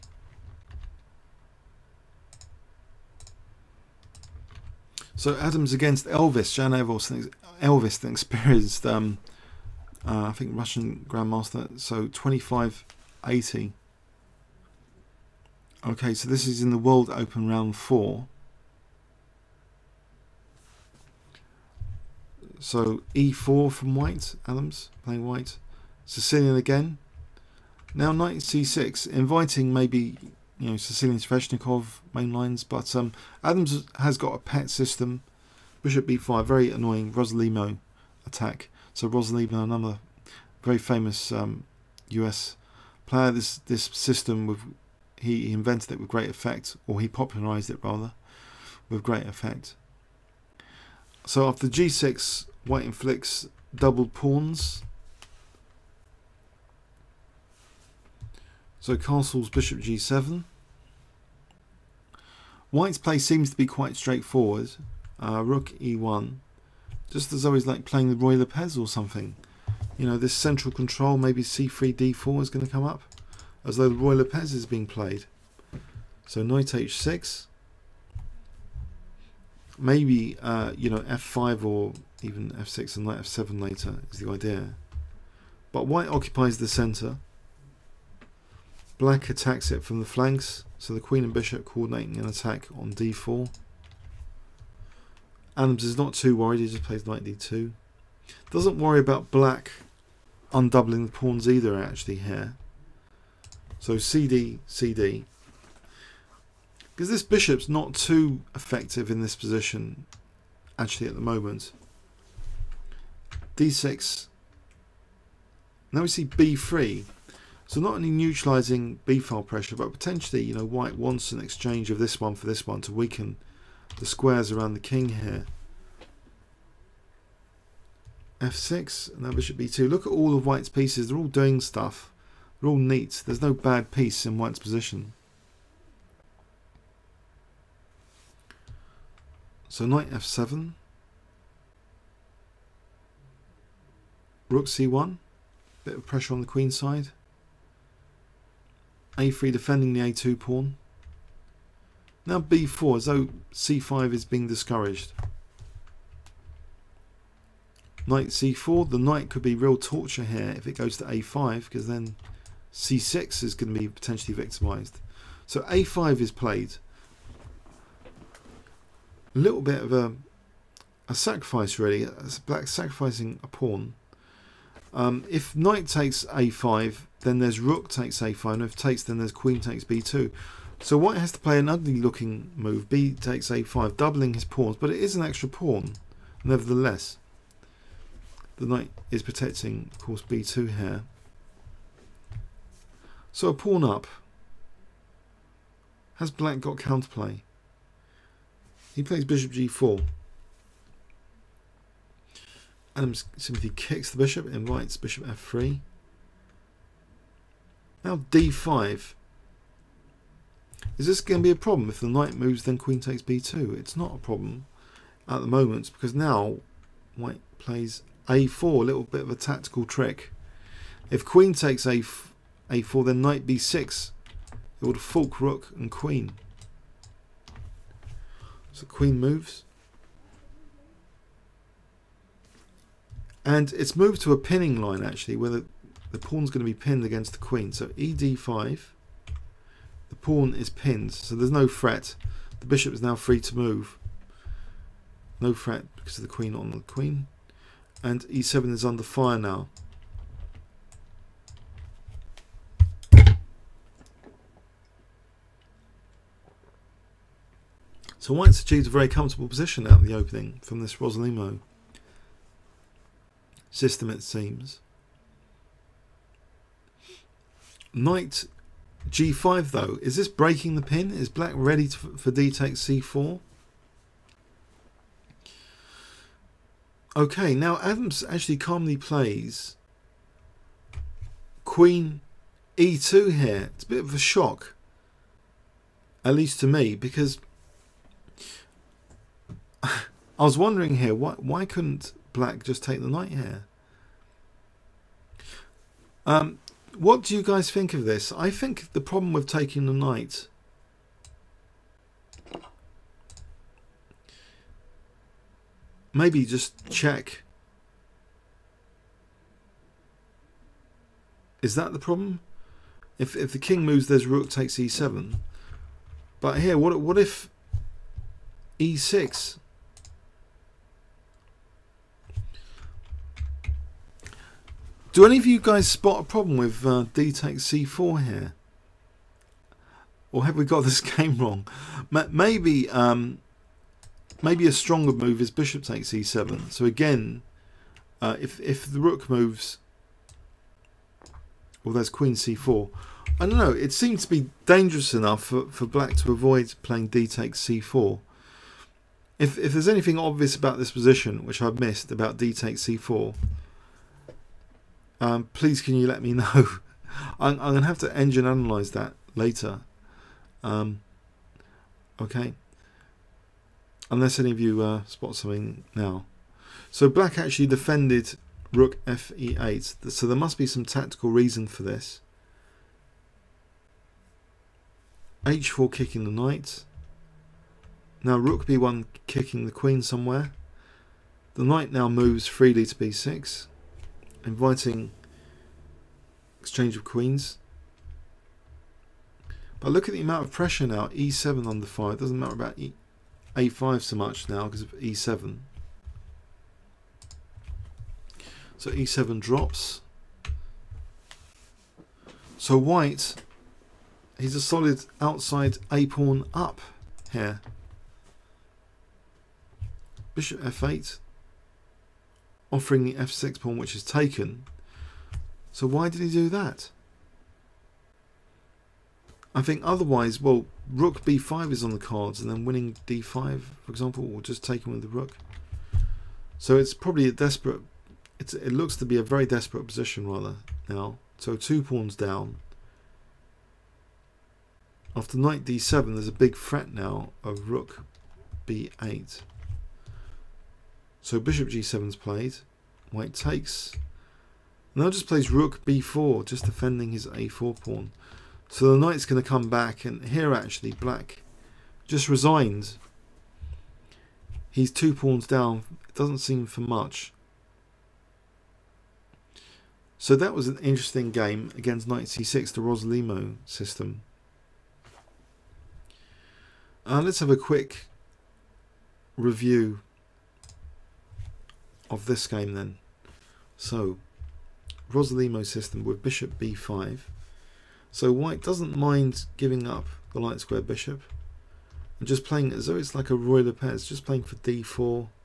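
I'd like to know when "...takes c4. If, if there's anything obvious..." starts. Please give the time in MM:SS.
05:47.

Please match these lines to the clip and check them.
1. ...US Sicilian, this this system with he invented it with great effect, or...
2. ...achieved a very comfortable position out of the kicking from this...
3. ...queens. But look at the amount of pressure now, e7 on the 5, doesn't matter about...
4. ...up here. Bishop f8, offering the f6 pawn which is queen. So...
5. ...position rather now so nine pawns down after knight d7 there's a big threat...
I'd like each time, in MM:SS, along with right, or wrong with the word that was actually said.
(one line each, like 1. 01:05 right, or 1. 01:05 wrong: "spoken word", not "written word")
1. 00:42 wrong: "Player", not "Sicilian"
2. 04:18 wrong: "opening", not "kicking"
3. 06:27 right
4. 06:46 wrong: "taken", not "queen"
5. 07:09 wrong: "two", not "nine".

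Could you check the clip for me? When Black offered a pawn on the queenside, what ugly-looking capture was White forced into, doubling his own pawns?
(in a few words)
B takes a5.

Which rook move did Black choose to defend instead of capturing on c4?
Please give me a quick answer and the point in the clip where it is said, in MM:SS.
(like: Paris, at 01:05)
Rook fe8, at 06:08.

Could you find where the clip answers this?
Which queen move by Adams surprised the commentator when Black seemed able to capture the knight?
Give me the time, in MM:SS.
04:41.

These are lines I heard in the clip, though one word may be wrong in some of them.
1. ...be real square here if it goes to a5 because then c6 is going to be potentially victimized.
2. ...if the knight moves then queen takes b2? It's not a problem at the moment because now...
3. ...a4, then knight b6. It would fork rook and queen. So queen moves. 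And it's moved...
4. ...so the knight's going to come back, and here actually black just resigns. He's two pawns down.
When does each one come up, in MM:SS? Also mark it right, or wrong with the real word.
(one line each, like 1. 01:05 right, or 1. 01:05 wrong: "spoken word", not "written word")
1. 02:39 wrong: "torture", not "square"
2. 03:31 right
3. 03:42 right
4. 07:28 right.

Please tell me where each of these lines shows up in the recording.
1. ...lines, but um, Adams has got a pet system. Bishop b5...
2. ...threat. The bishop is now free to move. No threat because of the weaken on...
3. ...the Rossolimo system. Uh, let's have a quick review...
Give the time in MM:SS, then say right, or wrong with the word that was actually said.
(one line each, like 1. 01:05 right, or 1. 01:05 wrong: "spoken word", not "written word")
1. 00:32 right
2. 04:01 wrong: "queen", not "weaken"
3. 07:42 right.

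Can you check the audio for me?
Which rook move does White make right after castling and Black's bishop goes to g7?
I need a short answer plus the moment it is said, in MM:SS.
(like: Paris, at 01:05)
Rook e1, at 01:05.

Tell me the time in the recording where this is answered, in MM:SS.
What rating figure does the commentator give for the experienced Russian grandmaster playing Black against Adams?
00:12.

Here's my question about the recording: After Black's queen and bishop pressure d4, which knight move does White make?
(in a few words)
Knight d2.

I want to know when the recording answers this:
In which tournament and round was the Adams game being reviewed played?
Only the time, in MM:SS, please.
00:16.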